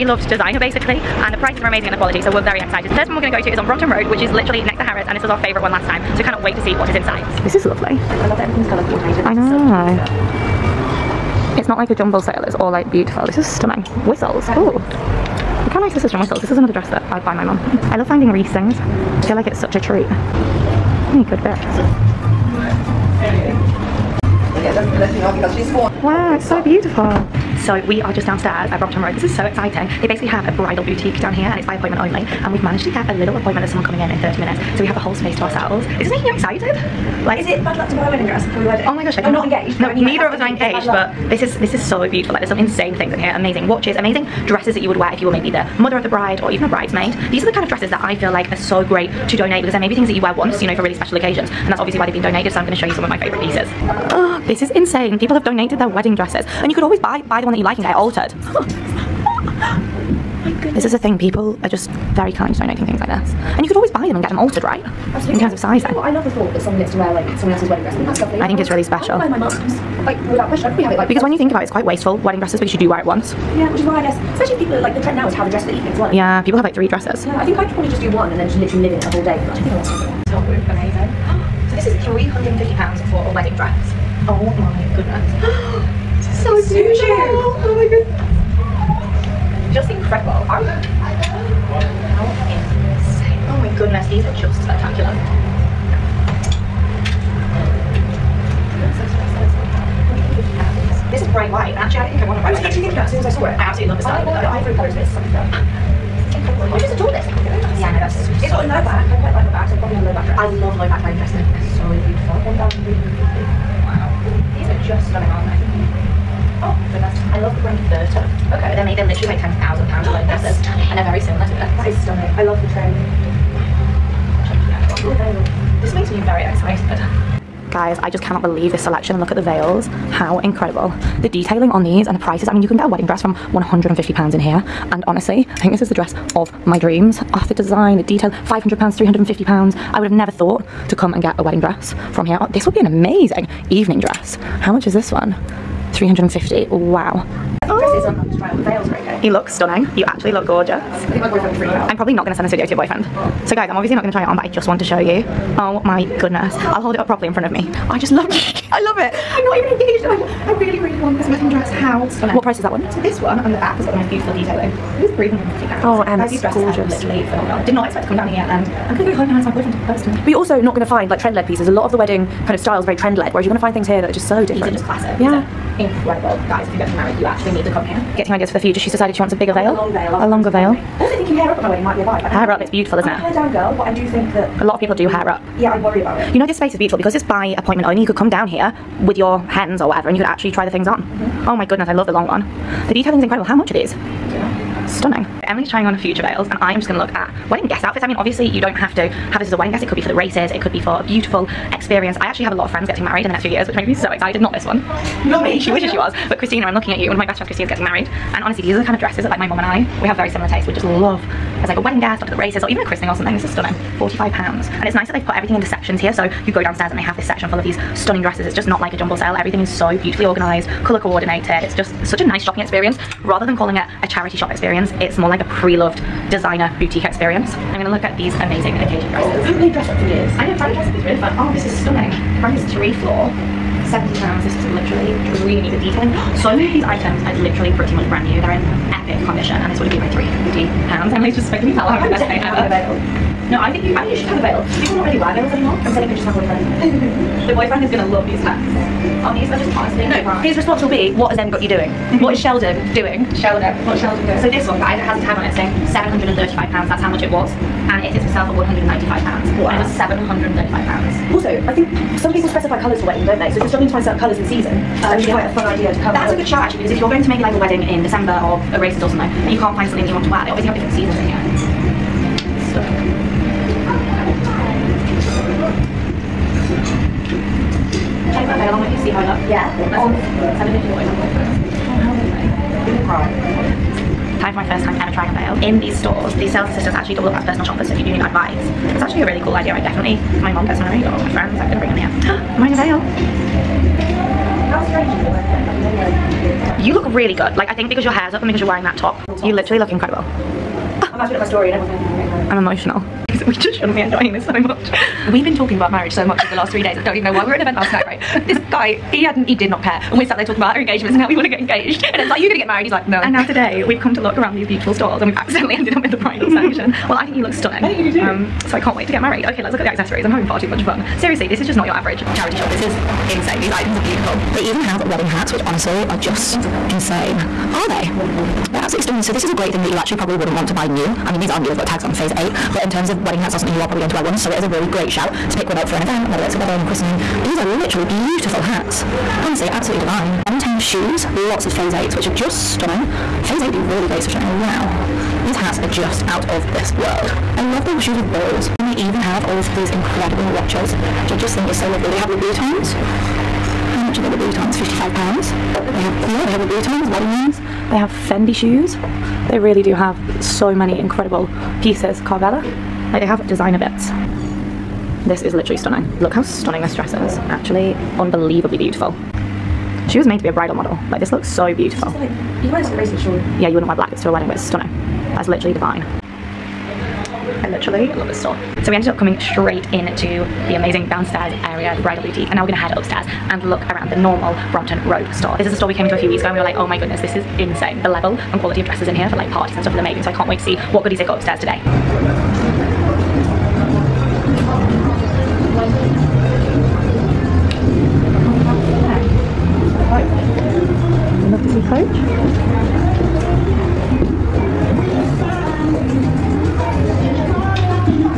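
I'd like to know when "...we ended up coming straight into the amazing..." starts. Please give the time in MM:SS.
06:18.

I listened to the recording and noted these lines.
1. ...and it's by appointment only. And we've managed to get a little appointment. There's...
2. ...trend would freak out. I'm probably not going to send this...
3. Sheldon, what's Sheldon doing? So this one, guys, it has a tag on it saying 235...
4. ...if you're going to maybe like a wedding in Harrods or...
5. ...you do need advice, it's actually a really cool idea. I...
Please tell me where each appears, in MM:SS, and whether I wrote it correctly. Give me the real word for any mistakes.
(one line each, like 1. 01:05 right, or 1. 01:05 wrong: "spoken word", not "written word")
1. 00:31 right
2. 02:31 wrong: "boyfriend", not "trend"
3. 04:13 wrong: "735", not "235"
4. 04:26 wrong: "December", not "Harrods"
5. 04:47 right.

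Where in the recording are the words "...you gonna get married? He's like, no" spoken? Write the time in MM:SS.
05:12.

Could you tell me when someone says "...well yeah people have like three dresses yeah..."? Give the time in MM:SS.
01:15.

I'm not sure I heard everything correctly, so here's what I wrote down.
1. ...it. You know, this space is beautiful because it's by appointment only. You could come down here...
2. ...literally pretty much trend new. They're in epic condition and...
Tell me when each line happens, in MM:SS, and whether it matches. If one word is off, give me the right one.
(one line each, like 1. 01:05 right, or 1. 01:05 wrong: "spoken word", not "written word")
1. 03:06 right
2. 03:57 wrong: "brand", not "trend".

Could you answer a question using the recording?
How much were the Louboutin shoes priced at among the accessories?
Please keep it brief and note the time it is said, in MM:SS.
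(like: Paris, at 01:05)
£55, at 05:54.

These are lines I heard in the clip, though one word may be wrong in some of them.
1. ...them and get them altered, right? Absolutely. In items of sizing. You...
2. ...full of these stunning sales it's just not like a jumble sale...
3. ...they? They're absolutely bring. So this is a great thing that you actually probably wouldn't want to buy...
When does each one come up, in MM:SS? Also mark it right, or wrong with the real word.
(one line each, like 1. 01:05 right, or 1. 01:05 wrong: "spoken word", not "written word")
1. 01:04 wrong: "terms", not "items"
2. 03:37 wrong: "dresses", not "sales"
3. 05:27 wrong: "stunning", not "bring".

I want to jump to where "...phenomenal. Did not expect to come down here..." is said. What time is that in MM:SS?
02:47.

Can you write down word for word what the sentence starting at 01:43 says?
I absolutely love the style I of it.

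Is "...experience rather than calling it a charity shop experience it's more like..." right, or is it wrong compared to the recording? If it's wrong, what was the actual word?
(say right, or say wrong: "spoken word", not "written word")
right.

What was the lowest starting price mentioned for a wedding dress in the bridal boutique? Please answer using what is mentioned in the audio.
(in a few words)
£150.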